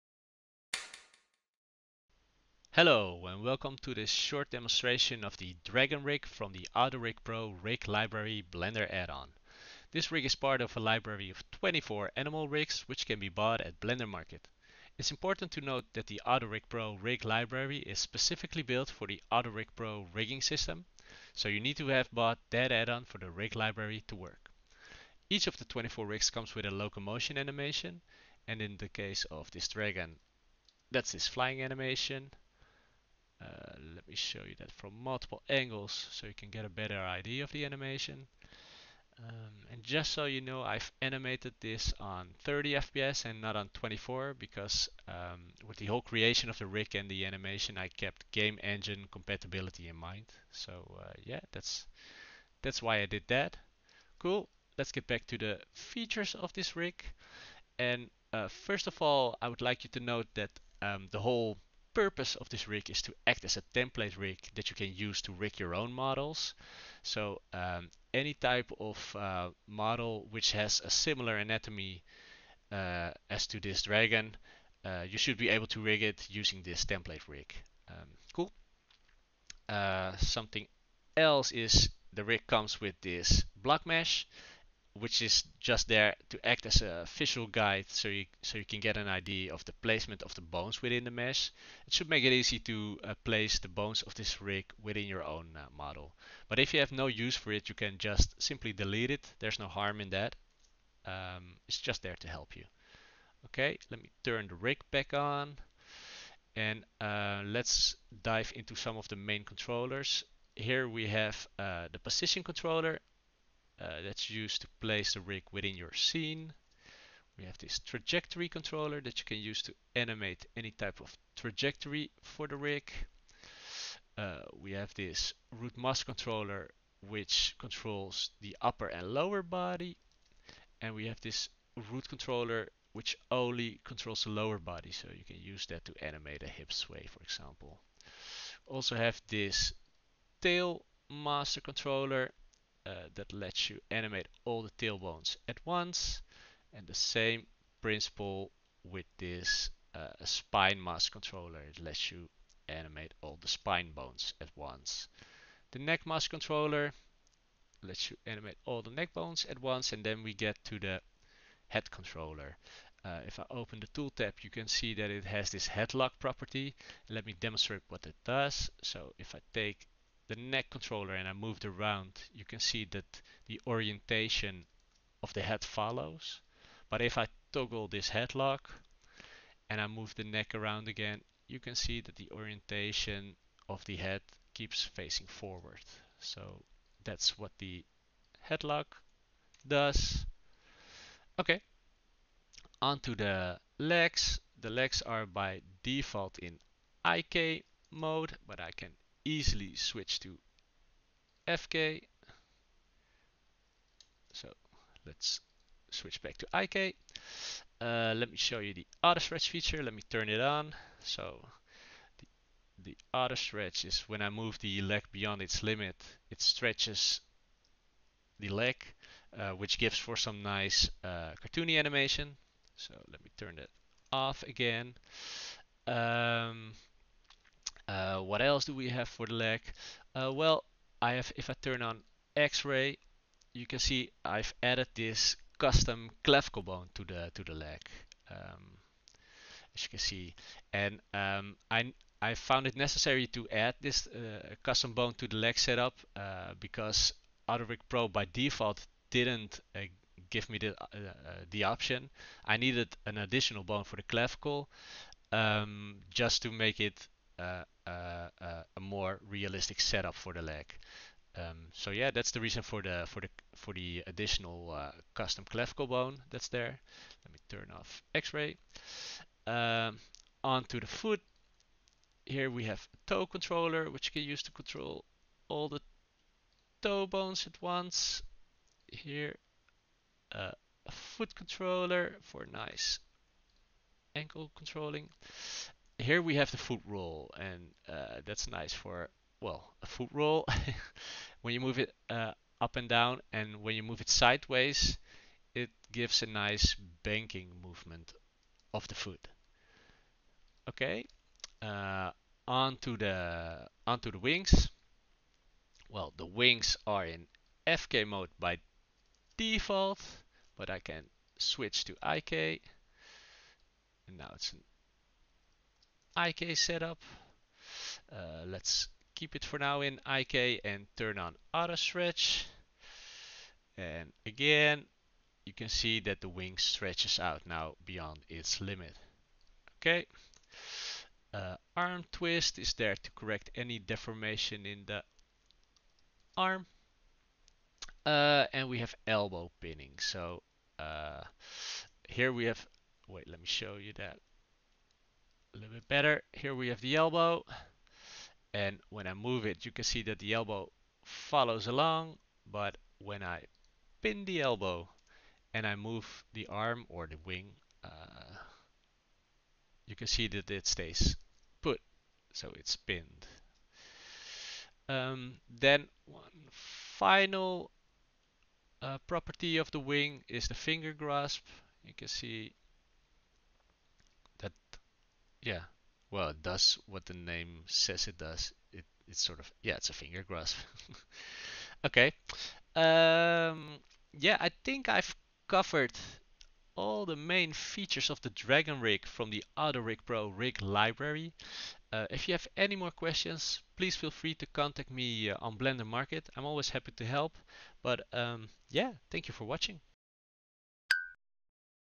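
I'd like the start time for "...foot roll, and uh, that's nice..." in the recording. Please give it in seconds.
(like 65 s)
286 s.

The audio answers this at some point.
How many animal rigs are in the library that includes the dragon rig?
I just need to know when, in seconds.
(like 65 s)
11 s.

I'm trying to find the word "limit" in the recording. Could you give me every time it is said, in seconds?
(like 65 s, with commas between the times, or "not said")
215 s, 328 s.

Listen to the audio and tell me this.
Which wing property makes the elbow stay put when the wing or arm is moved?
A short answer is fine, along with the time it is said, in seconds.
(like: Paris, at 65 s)
elbow pinning, at 339 s.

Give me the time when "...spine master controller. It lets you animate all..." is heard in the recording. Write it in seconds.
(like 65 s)
150 s.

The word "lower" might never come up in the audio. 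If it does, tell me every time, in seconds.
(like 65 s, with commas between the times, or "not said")
129 s, 134 s.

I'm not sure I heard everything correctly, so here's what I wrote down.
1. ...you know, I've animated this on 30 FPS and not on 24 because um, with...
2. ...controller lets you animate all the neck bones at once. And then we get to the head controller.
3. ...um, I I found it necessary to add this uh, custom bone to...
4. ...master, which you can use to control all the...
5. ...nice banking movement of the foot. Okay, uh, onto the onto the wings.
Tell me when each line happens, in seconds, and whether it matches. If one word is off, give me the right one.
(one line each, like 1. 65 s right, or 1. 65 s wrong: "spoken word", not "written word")
1. 40 s right
2. 156 s right
3. 241 s right
4. 273 s wrong: "controller", not "master"
5. 296 s right.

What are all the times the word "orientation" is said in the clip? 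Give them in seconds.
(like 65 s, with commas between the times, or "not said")
173 s, 182 s.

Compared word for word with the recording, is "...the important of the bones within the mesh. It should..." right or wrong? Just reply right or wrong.
wrong.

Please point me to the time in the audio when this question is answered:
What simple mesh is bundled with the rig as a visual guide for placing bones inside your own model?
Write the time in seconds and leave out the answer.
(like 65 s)
83 s.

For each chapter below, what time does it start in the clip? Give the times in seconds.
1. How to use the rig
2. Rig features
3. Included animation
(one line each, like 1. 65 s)
1. 58 s
2. 107 s
3. 25 s.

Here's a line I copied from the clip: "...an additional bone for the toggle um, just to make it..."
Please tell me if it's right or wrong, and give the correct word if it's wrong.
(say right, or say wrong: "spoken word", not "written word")
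wrong: "clavicle", not "toggle".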